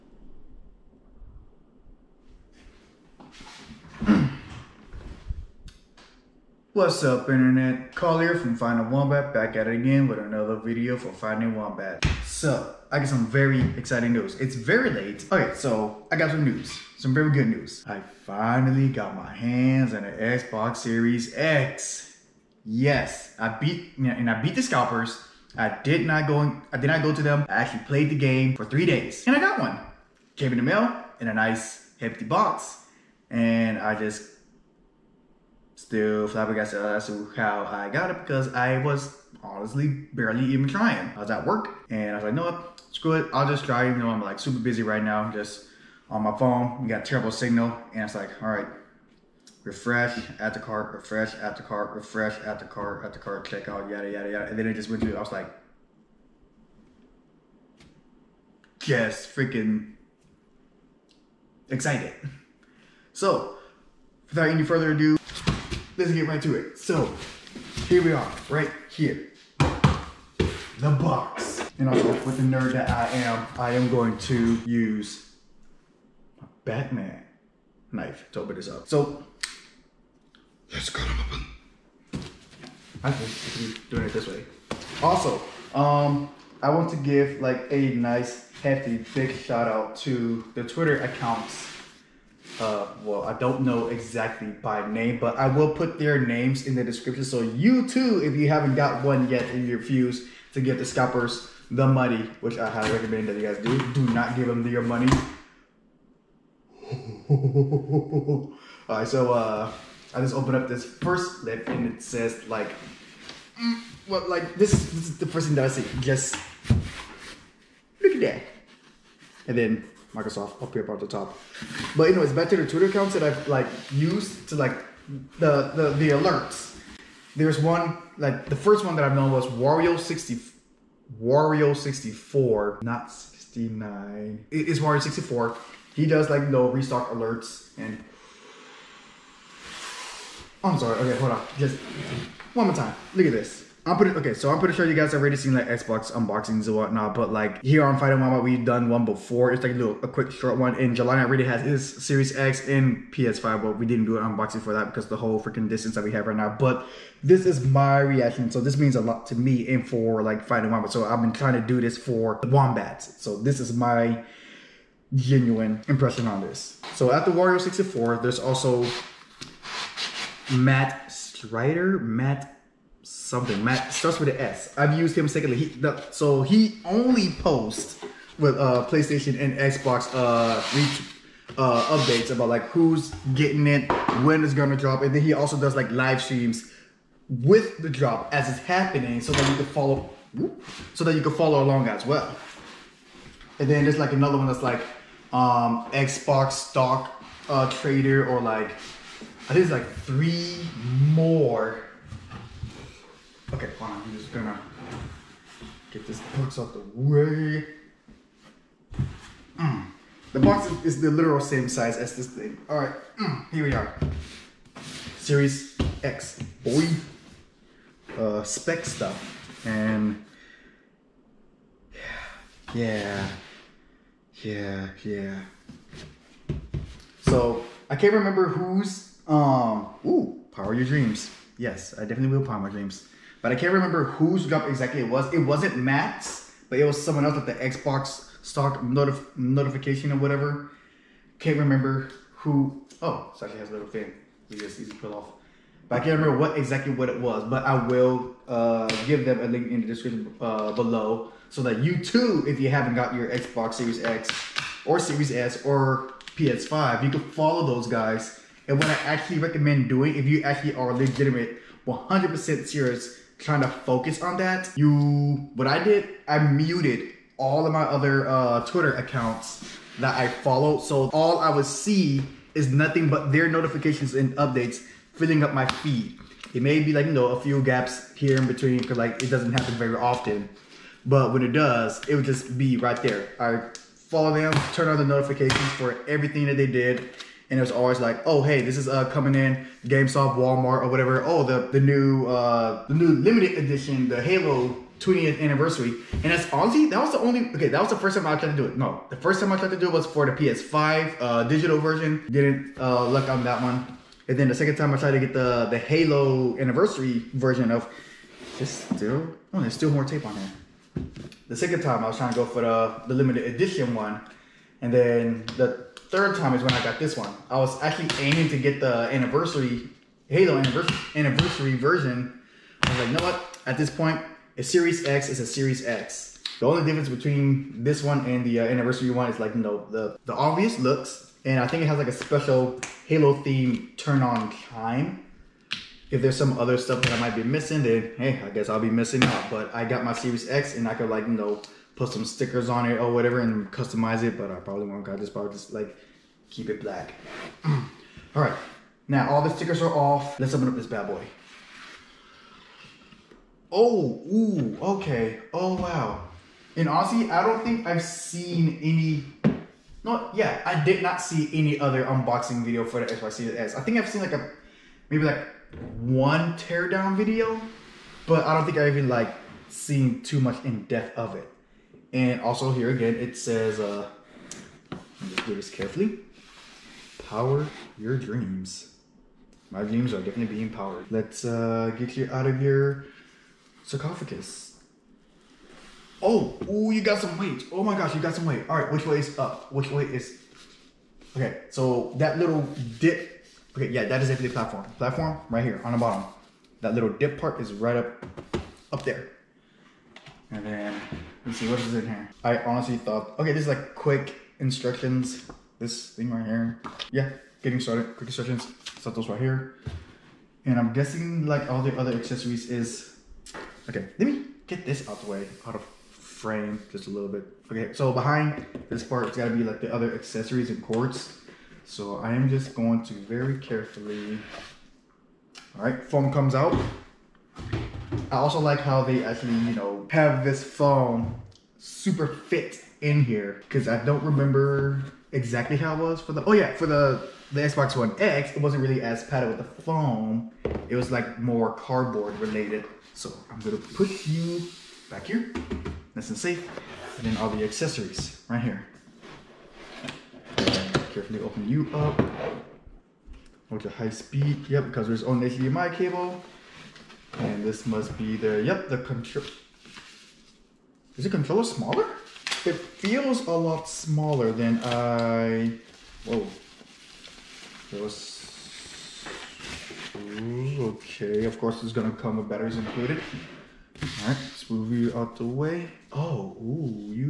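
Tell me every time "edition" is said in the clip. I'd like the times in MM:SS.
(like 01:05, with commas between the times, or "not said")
04:53, 05:13.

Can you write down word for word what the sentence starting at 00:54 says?
And then it just went to, I was like, just freaking excited.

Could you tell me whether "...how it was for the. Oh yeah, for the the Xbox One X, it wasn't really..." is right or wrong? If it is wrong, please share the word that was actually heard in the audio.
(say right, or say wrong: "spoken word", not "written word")
right.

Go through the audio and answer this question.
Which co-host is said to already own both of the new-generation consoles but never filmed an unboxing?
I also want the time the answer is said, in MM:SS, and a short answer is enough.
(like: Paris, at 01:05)
Jelani, at 02:30.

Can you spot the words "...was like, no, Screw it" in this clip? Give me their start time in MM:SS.
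00:42.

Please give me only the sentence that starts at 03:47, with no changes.
So I can't remember who's um.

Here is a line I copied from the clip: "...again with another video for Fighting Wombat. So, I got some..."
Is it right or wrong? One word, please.
right.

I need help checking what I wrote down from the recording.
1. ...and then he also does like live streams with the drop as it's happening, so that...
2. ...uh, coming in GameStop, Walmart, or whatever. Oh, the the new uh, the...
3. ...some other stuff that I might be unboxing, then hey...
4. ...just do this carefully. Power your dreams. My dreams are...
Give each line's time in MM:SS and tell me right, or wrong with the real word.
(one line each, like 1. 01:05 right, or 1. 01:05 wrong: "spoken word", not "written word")
1. 03:05 right
2. 04:48 right
3. 05:36 wrong: "missing", not "unboxing"
4. 06:15 right.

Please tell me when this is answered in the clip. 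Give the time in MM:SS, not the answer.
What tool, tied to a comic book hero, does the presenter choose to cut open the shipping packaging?
01:16.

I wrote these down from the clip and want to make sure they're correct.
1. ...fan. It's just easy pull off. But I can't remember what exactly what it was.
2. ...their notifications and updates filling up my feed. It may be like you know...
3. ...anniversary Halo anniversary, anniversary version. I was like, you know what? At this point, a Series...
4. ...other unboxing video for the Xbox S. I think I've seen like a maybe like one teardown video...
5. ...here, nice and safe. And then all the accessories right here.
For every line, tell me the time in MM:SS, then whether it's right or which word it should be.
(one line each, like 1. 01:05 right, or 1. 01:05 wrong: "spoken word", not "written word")
1. 04:03 right
2. 04:33 right
3. 05:19 right
4. 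06:01 right
5. 07:25 right.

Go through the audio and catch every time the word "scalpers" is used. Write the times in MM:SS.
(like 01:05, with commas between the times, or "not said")
00:24, 01:40.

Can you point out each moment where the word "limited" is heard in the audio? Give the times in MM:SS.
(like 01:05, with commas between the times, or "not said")
04:53, 05:13.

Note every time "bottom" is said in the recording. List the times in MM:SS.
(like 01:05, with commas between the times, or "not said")
06:35.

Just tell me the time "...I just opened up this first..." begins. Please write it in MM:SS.
01:50.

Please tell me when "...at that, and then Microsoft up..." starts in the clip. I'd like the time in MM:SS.
01:58.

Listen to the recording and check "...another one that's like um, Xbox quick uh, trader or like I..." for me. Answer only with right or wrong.
wrong.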